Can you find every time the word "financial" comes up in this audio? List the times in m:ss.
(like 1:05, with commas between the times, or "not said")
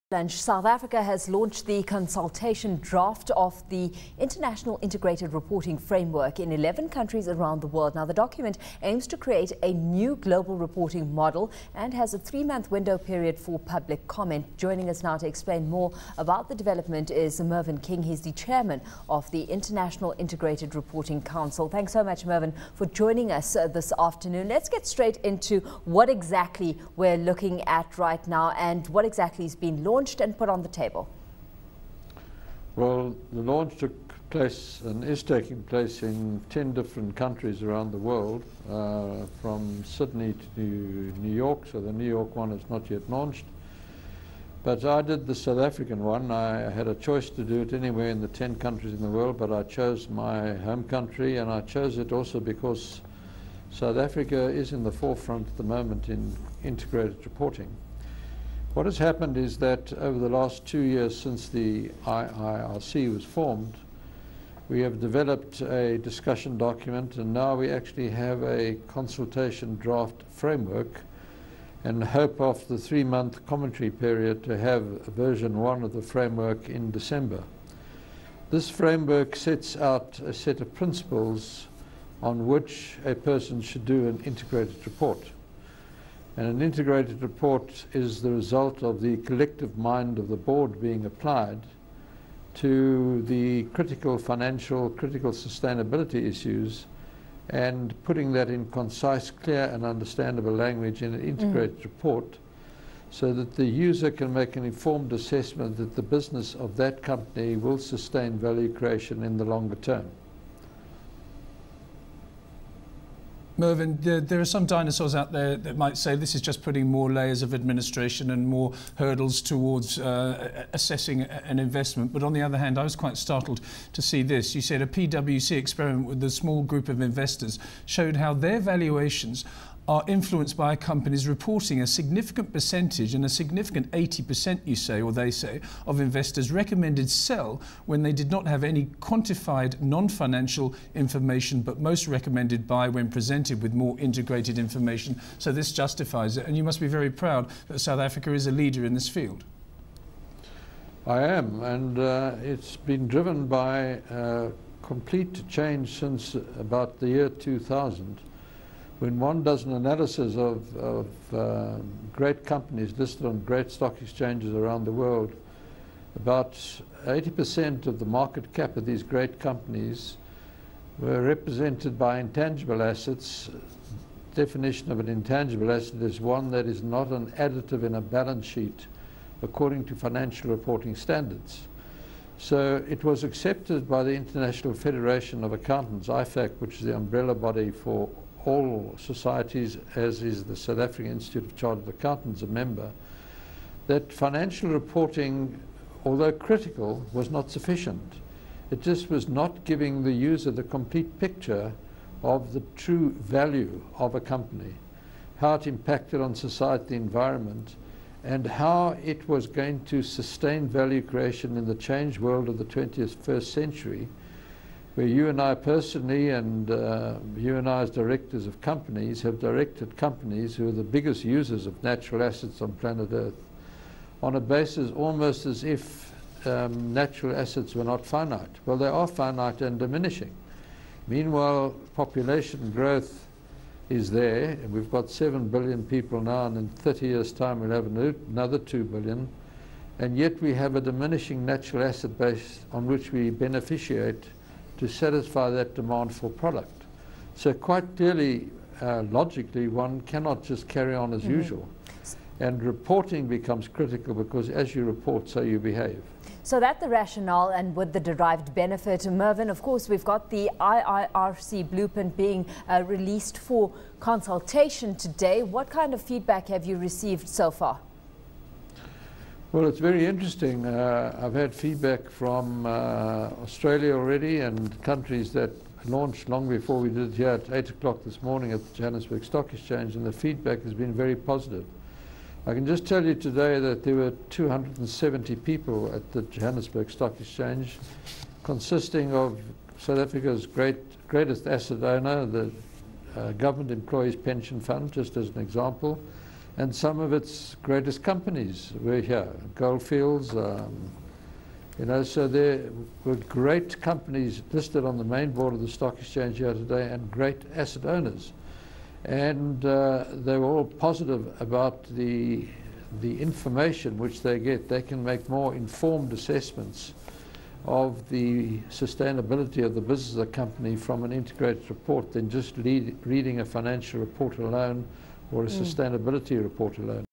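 1:34, 2:20, 2:59, 3:14, 5:23.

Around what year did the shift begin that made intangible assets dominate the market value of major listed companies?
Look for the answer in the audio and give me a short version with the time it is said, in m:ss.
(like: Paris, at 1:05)
2000, at 2:37.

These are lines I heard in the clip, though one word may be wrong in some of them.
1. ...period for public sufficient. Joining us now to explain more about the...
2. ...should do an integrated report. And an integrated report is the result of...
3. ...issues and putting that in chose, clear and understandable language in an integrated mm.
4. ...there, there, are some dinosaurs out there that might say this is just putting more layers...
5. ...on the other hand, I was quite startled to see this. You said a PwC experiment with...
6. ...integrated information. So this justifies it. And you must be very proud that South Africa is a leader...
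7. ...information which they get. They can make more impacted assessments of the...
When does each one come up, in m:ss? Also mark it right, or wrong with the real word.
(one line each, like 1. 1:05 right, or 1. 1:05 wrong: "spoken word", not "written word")
1. 0:12 wrong: "comment", not "sufficient"
2. 1:23 right
3. 1:36 wrong: "concise", not "chose"
4. 1:54 right
5. 2:02 right
6. 2:23 right
7. 5:13 wrong: "informed", not "impacted".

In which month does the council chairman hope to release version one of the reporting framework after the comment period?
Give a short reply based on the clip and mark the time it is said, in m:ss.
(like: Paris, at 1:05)
December, at 1:16.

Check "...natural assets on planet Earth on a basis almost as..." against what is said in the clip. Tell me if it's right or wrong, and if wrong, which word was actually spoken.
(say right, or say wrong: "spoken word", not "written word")
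right.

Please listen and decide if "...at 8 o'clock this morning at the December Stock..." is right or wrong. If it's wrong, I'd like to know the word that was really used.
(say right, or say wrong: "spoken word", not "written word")
wrong: "Johannesburg", not "December".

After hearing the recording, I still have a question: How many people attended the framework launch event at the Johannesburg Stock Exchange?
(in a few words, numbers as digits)
270.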